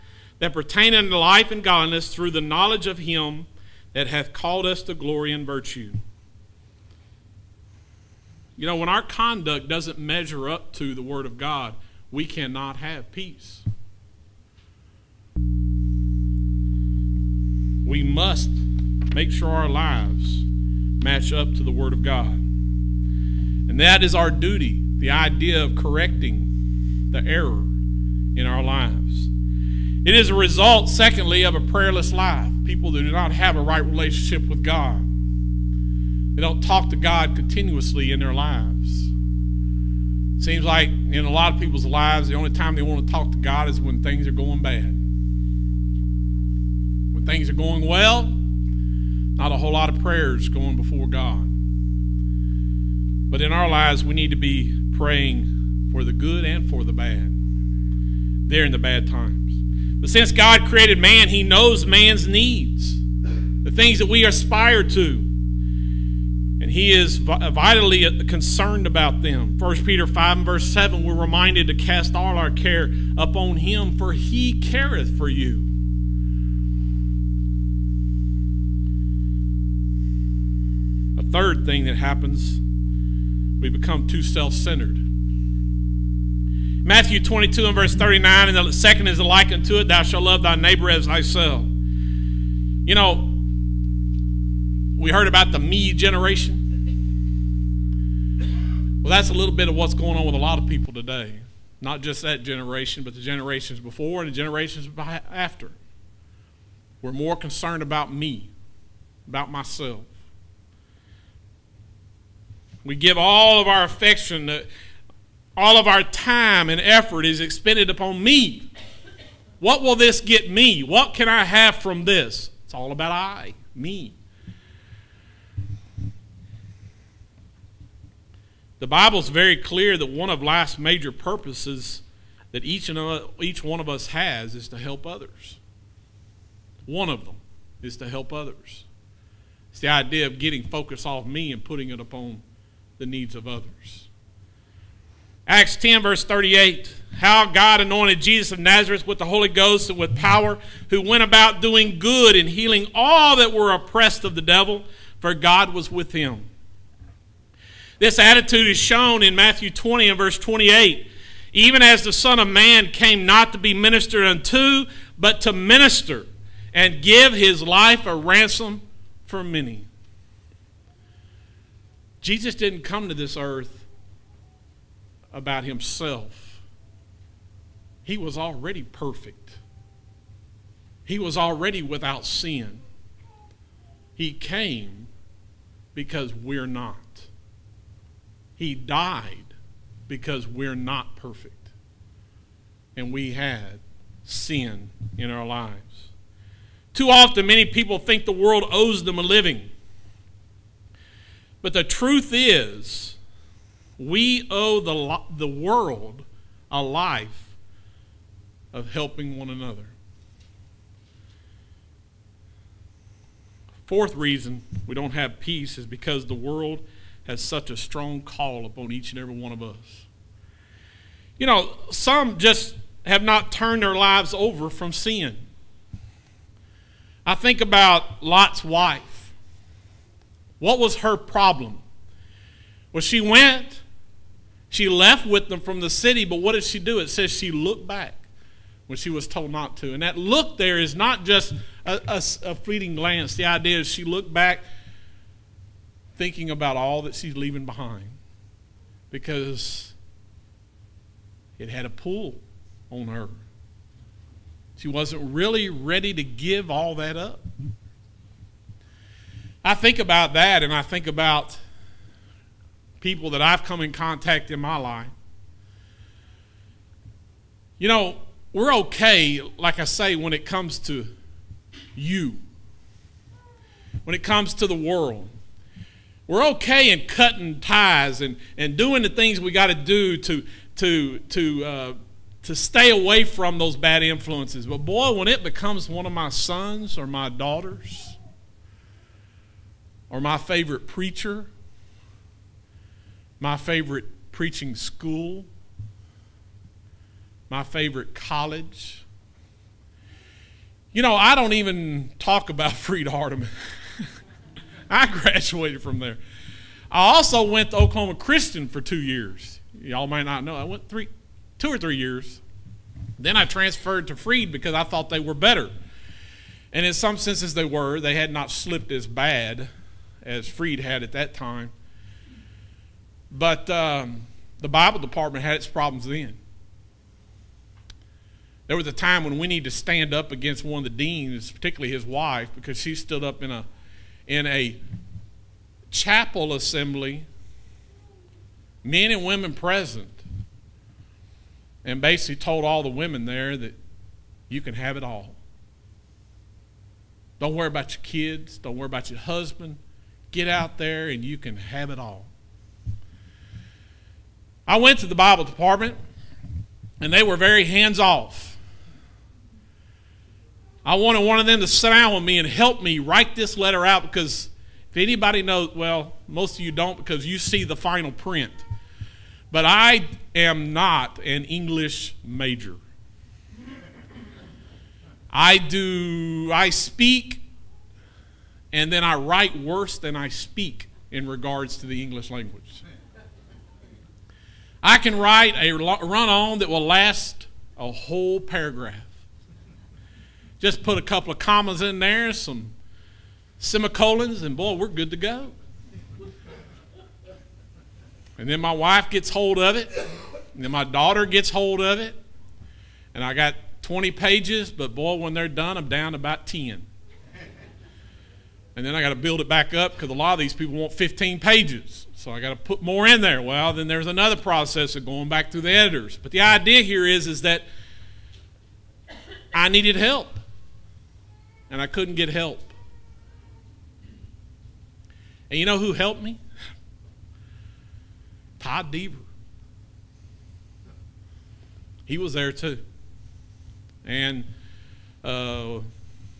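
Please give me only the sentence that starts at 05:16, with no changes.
And in some senses, they were.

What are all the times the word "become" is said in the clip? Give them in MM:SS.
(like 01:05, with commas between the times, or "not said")
01:23, 04:45.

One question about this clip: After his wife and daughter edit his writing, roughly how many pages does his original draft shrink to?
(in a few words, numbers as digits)
10.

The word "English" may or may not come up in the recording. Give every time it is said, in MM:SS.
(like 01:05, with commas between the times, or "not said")
06:11, 06:22.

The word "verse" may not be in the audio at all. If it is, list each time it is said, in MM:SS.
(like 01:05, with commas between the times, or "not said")
01:10, 01:27, 02:26, 02:40.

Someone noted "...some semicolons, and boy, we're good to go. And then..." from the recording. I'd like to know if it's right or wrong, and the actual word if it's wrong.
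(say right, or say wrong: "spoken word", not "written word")
right.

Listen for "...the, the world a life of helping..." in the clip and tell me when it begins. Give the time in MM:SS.
03:24.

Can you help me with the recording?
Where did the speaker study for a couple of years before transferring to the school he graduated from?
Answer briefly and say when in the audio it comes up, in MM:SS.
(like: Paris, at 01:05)
Oklahoma Christian, at 05:07.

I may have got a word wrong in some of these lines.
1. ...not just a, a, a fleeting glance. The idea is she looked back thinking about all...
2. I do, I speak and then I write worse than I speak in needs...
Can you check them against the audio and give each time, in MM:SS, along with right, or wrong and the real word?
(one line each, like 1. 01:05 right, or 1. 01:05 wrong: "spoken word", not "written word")
1. 04:00 right
2. 06:15 wrong: "regards", not "needs".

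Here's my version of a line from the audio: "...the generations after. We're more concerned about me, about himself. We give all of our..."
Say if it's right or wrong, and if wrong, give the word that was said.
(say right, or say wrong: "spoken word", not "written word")
wrong: "myself", not "himself".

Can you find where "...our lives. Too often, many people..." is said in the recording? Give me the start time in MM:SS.
03:15.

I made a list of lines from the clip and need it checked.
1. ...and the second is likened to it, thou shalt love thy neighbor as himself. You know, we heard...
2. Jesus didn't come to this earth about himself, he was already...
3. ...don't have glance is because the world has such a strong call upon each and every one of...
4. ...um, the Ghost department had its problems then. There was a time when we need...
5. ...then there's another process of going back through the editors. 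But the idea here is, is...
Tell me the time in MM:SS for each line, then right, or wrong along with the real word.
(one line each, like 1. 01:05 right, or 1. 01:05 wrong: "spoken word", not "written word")
1. 01:28 wrong: "thyself", not "himself"
2. 02:52 right
3. 03:34 wrong: "peace", not "glance"
4. 05:23 wrong: "Bible", not "Ghost"
5. 06:53 right.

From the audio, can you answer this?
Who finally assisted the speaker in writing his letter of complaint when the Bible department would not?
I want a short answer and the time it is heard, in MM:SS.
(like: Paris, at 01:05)
Todd Deaver, at 07:08.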